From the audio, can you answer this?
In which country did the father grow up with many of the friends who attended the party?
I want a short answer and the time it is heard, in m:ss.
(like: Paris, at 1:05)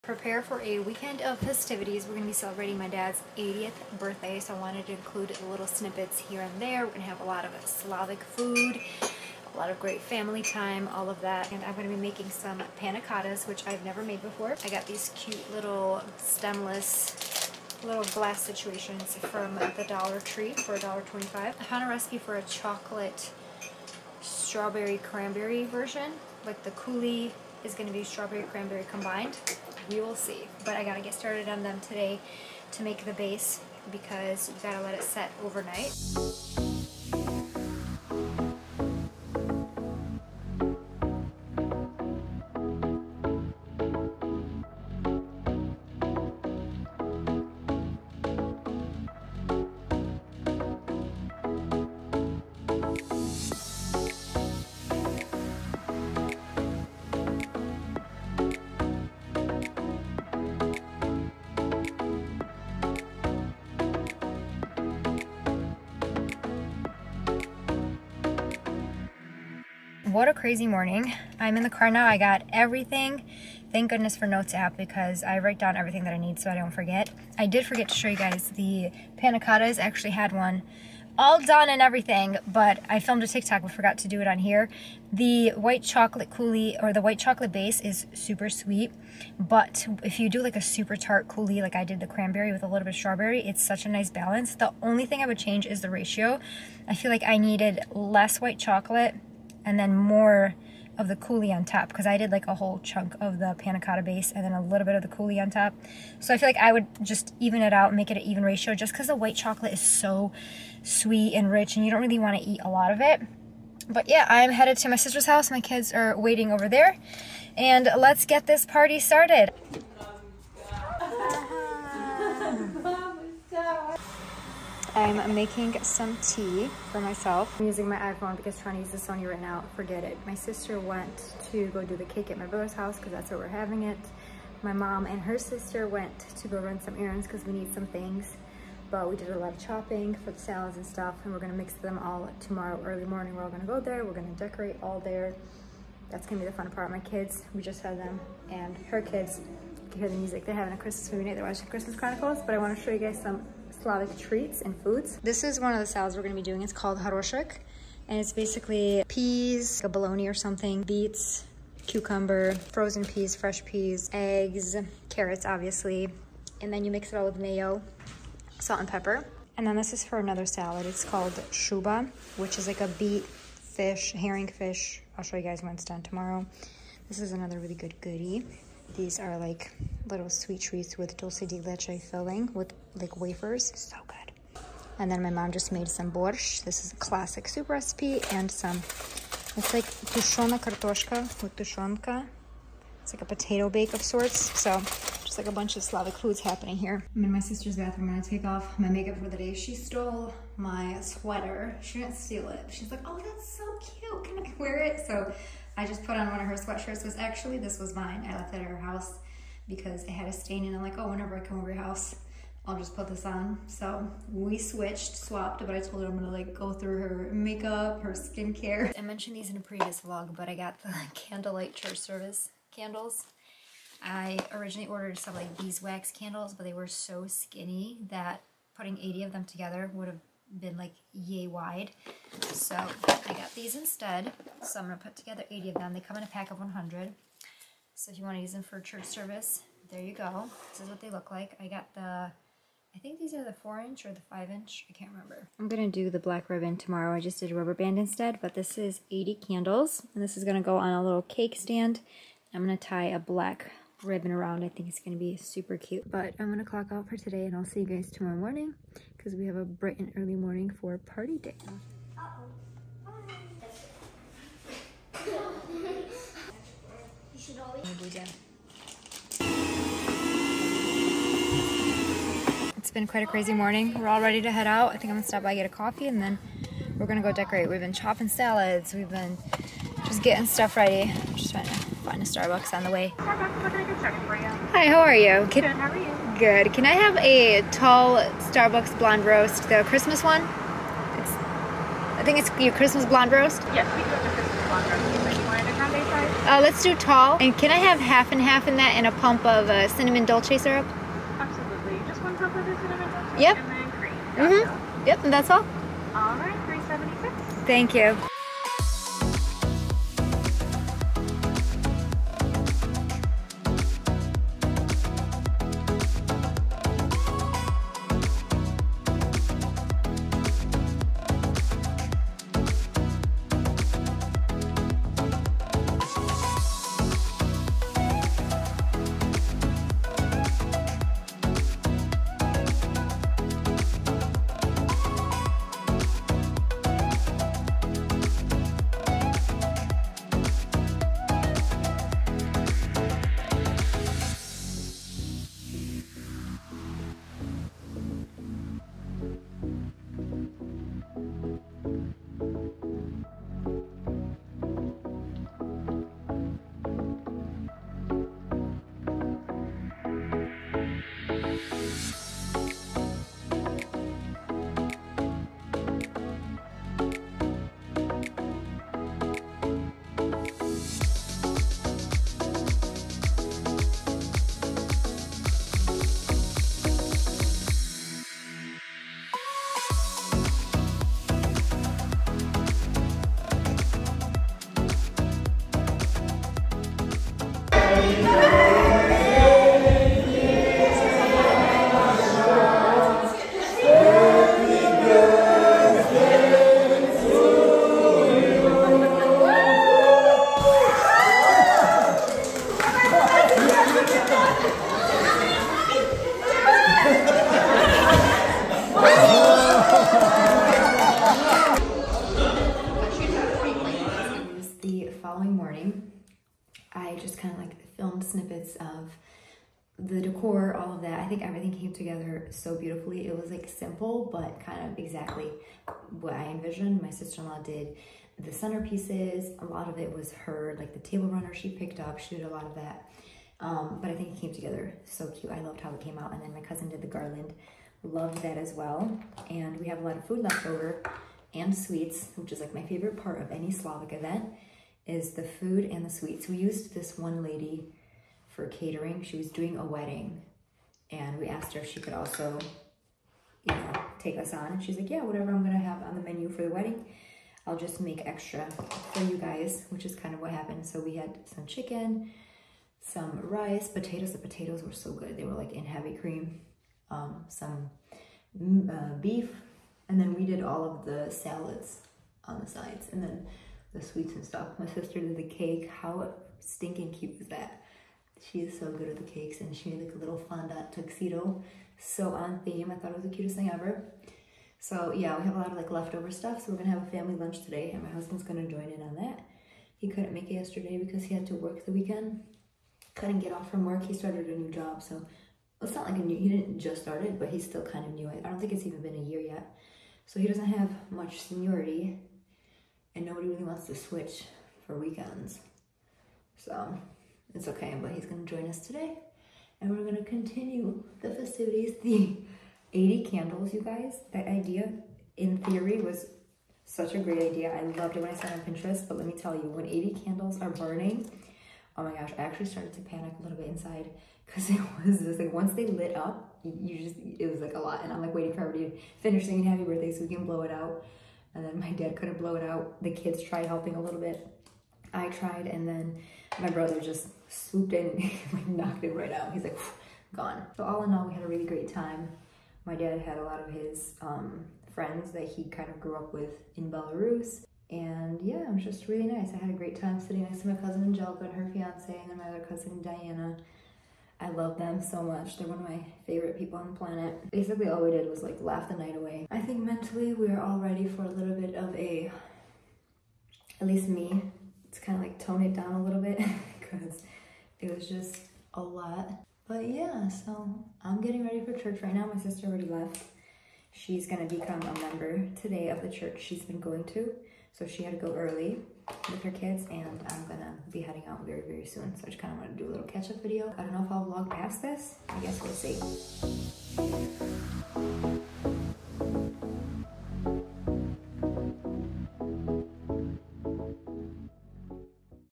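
Belarus, at 9:06.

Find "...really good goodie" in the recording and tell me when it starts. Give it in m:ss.
2:57.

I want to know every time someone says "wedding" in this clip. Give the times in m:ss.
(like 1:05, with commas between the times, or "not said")
7:29, 7:36.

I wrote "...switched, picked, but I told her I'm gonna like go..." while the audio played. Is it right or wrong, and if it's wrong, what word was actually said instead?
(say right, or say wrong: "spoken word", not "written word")
wrong: "swapped", not "picked".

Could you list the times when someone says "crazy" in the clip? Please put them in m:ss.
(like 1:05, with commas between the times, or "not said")
1:10, 4:33.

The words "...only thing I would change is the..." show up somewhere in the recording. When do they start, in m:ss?
1:34.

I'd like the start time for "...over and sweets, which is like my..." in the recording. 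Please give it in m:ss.
7:20.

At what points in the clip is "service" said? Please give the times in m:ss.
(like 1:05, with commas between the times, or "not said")
3:41, 3:59.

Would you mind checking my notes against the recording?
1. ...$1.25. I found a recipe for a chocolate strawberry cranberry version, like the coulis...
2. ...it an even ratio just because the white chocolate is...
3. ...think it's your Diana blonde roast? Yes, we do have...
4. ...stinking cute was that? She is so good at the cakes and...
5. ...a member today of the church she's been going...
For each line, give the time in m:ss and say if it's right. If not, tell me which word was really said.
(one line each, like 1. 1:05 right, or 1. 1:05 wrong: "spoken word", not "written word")
1. 0:20 right
2. 1:48 right
3. 4:52 wrong: "Christmas", not "Diana"
4. 7:56 right
5. 9:34 right.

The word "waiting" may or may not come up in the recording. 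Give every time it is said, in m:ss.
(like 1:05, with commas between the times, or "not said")
1:56, 8:48.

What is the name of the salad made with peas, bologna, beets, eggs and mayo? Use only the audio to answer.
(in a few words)
haroshek.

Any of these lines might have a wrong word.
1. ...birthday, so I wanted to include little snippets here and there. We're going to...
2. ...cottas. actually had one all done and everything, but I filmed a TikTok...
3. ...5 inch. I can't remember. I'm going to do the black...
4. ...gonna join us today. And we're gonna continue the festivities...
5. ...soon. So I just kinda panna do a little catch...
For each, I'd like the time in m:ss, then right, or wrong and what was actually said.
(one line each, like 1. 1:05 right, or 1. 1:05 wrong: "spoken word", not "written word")
1. 0:03 right
2. 1:19 right
3. 4:04 right
4. 8:28 right
5. 9:41 wrong: "wanna", not "panna".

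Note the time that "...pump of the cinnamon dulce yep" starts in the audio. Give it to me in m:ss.
5:02.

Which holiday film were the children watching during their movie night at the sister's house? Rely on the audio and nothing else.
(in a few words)
Christmas Chronicles.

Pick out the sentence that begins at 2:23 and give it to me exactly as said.
We're all gonna go there, we're gonna decorate all there.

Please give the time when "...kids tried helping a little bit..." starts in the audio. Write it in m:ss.
8:53.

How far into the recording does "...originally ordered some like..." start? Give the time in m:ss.
3:44.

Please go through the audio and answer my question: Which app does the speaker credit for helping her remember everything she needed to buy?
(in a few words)
Notes.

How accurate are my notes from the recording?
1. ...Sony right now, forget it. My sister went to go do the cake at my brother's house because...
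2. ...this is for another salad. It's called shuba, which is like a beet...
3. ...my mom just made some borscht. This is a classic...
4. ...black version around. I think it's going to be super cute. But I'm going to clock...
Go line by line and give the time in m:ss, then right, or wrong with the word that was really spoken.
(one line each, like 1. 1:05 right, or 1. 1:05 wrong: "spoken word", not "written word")
1. 2:08 right
2. 2:49 right
3. 3:05 right
4. 4:13 wrong: "ribbon", not "version".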